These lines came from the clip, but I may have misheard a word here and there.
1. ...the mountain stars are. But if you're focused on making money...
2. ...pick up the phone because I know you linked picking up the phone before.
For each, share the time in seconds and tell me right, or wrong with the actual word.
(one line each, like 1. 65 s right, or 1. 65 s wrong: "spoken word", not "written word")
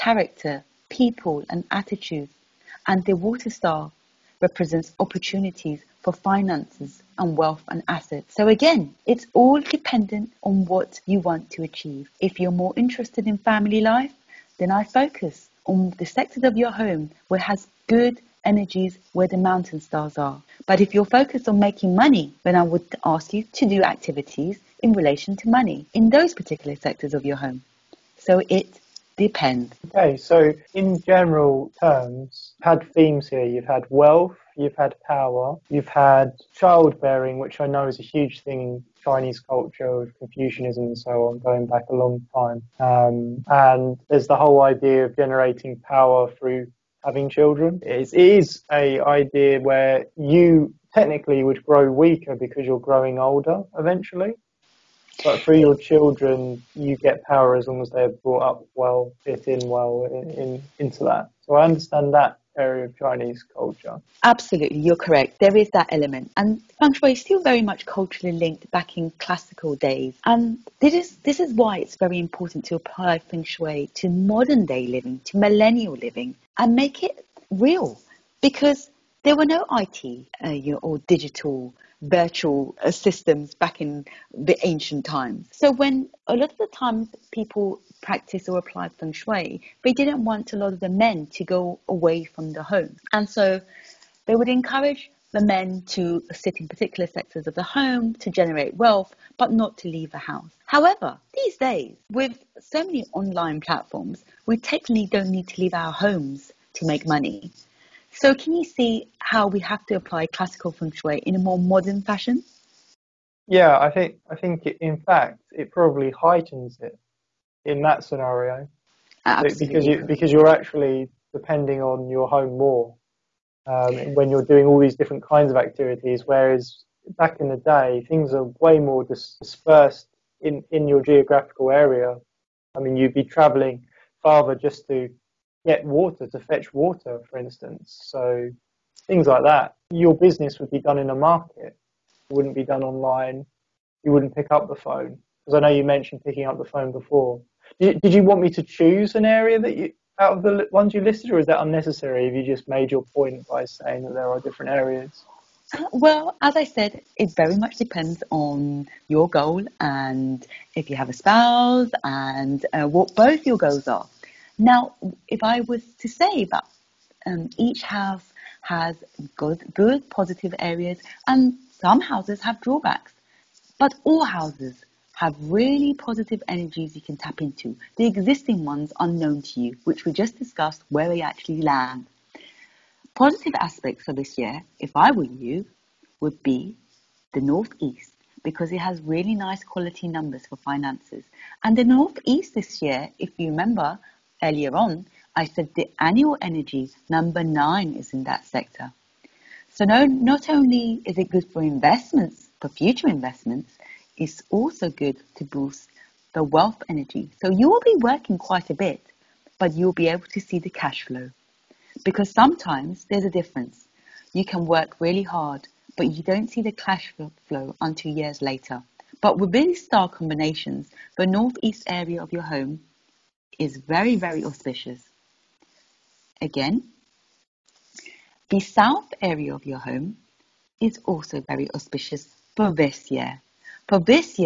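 1. 19 s right
2. 144 s wrong: "mentioned", not "linked".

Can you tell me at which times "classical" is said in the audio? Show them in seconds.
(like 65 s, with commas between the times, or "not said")
69 s, 110 s.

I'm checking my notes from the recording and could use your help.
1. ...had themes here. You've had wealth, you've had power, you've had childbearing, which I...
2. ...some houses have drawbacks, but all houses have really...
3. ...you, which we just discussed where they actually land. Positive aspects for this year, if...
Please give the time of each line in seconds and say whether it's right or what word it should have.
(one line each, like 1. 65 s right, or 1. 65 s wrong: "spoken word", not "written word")
1. 32 s right
2. 171 s right
3. 179 s right.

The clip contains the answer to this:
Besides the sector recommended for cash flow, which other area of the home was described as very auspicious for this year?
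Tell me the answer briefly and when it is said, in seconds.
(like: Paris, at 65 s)
South, at 228 s.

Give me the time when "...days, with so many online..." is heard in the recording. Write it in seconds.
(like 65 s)
101 s.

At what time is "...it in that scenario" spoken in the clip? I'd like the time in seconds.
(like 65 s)
116 s.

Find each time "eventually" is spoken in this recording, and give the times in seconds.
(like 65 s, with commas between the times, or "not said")
53 s.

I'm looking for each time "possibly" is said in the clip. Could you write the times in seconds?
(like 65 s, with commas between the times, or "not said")
not said.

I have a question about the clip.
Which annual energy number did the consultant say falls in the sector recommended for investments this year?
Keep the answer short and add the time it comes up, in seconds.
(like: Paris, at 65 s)
9, at 197 s.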